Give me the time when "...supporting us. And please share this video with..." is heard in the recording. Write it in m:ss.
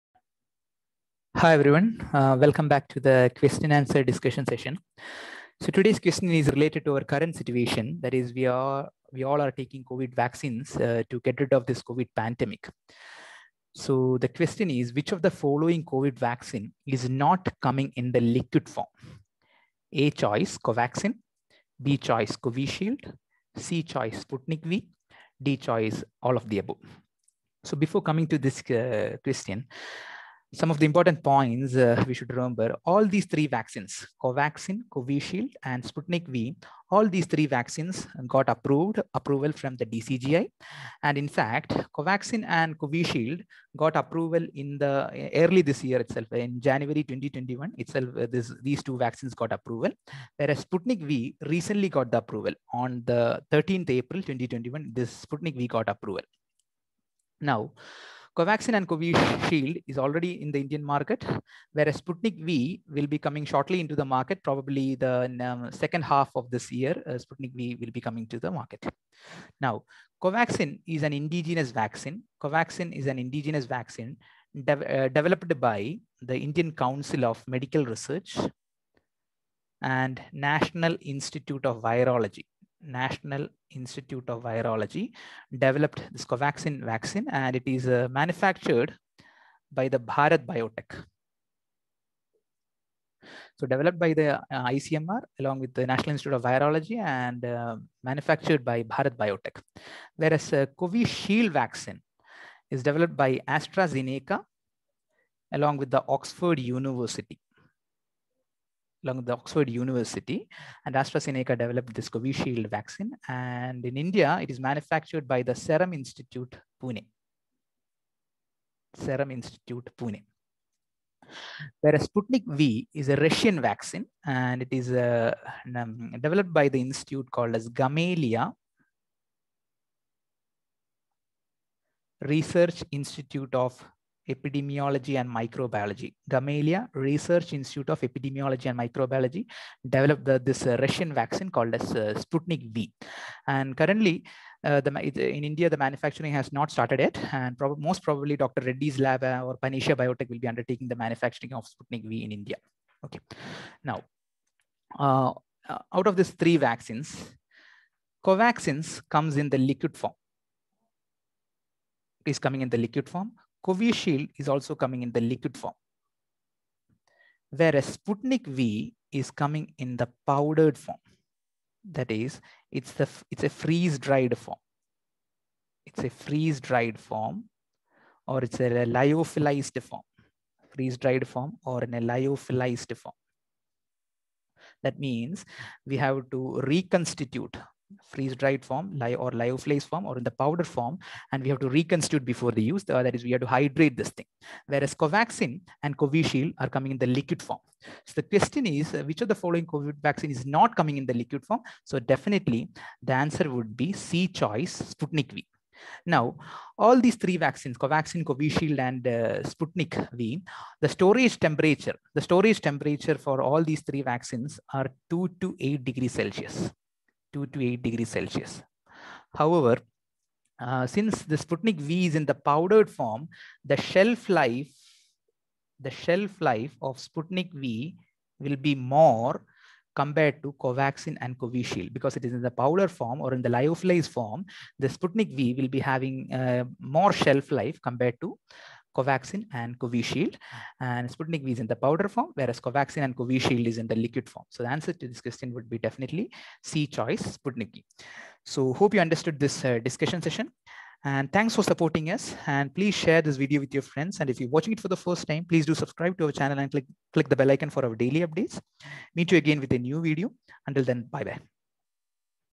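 4:11.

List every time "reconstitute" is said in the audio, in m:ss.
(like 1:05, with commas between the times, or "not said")
3:06, 3:11.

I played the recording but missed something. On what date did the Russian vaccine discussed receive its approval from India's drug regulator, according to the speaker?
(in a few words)
13th April 2021.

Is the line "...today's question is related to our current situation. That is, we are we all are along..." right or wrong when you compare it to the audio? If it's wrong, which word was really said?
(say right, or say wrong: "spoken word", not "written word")
wrong: "taking", not "along".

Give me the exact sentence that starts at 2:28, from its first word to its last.
Reddy's lab uh, or Panacea Biotech will be undertaking the manufacturing of Sputnik V in India.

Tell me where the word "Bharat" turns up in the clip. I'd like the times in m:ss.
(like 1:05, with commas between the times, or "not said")
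1:29, 1:38.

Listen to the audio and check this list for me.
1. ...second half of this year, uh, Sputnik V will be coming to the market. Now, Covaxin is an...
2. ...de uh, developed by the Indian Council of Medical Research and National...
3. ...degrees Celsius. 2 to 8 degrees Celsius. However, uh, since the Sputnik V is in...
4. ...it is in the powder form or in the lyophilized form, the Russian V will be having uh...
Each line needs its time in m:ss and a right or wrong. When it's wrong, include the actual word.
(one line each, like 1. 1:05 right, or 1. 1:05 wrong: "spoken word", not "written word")
1. 1:05 right
2. 1:14 right
3. 3:35 right
4. 3:52 wrong: "Sputnik", not "Russian".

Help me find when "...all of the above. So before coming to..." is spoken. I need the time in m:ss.
0:26.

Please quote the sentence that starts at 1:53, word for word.
And in India, it is manufactured by the Serum Institute Pune.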